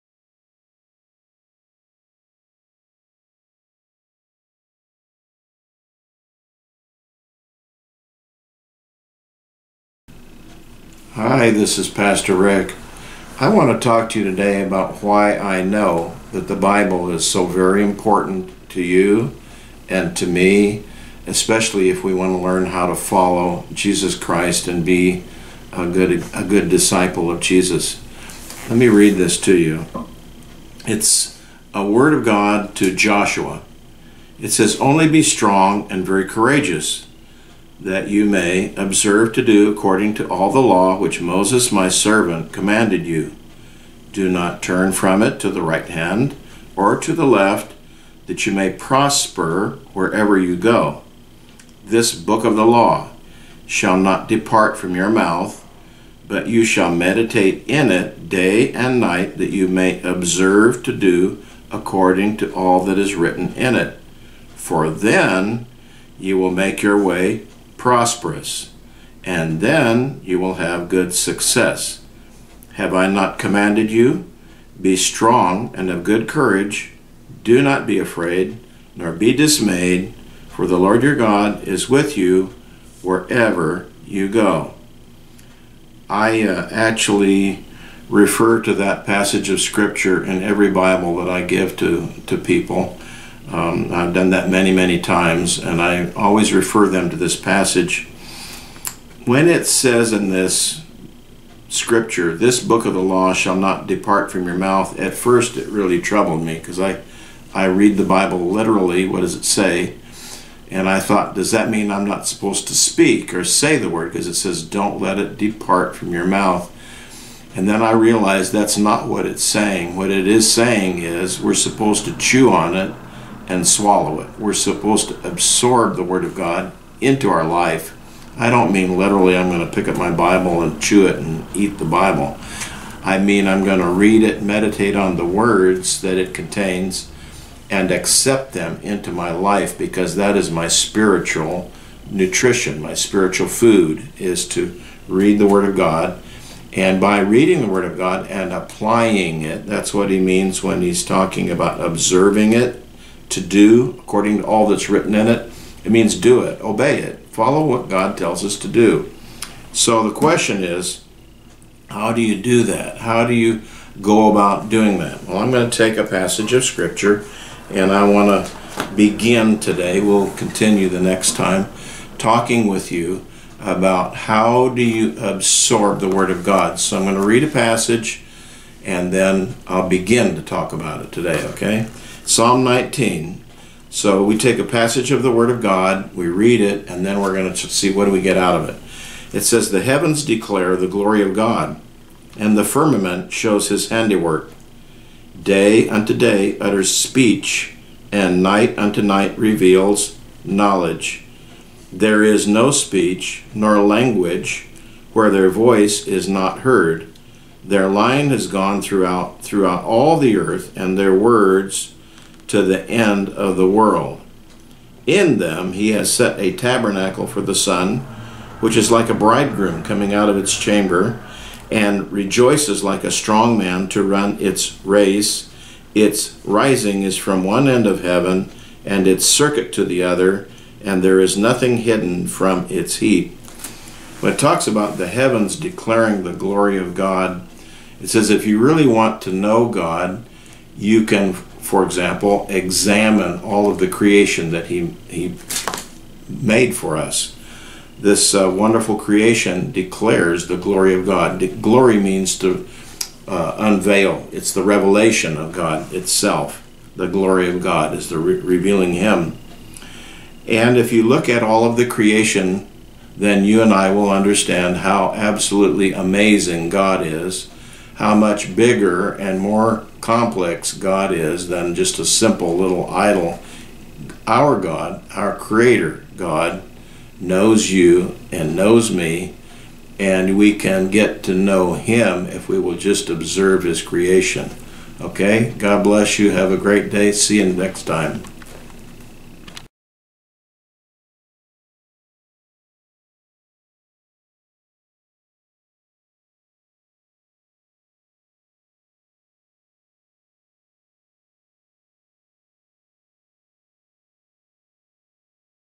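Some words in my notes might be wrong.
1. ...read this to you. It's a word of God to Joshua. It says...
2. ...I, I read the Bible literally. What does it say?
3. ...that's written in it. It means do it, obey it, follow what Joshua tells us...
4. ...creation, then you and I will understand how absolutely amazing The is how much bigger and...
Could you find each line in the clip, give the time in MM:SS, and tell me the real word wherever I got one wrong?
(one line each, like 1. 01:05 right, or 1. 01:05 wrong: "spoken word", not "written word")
1. 00:28 right
2. 01:46 right
3. 02:34 wrong: "God", not "Joshua"
4. 04:21 wrong: "God", not "The".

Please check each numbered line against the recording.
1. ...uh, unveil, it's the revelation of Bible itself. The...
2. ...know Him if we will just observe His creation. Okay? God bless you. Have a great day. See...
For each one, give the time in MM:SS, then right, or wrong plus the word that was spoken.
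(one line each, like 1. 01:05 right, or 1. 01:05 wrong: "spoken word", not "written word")
1. 04:13 wrong: "God", not "Bible"
2. 04:41 right.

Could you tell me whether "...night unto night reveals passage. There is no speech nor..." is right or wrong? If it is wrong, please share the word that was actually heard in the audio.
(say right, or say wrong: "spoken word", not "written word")
wrong: "knowledge", not "passage".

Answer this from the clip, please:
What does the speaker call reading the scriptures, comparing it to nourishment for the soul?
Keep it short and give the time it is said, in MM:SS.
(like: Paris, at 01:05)
Spiritual food, at 02:22.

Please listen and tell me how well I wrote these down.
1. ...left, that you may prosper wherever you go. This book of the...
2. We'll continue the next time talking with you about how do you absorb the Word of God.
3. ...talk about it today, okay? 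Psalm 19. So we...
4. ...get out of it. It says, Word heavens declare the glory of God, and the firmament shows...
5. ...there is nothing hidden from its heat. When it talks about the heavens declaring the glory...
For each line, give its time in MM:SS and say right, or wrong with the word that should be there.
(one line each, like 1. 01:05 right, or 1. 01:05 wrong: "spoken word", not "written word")
1. 00:47 right
2. 02:50 right
3. 03:00 right
4. 03:08 wrong: "The", not "Word"
5. 03:51 right.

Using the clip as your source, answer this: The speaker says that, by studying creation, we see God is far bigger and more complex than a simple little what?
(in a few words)
Idol.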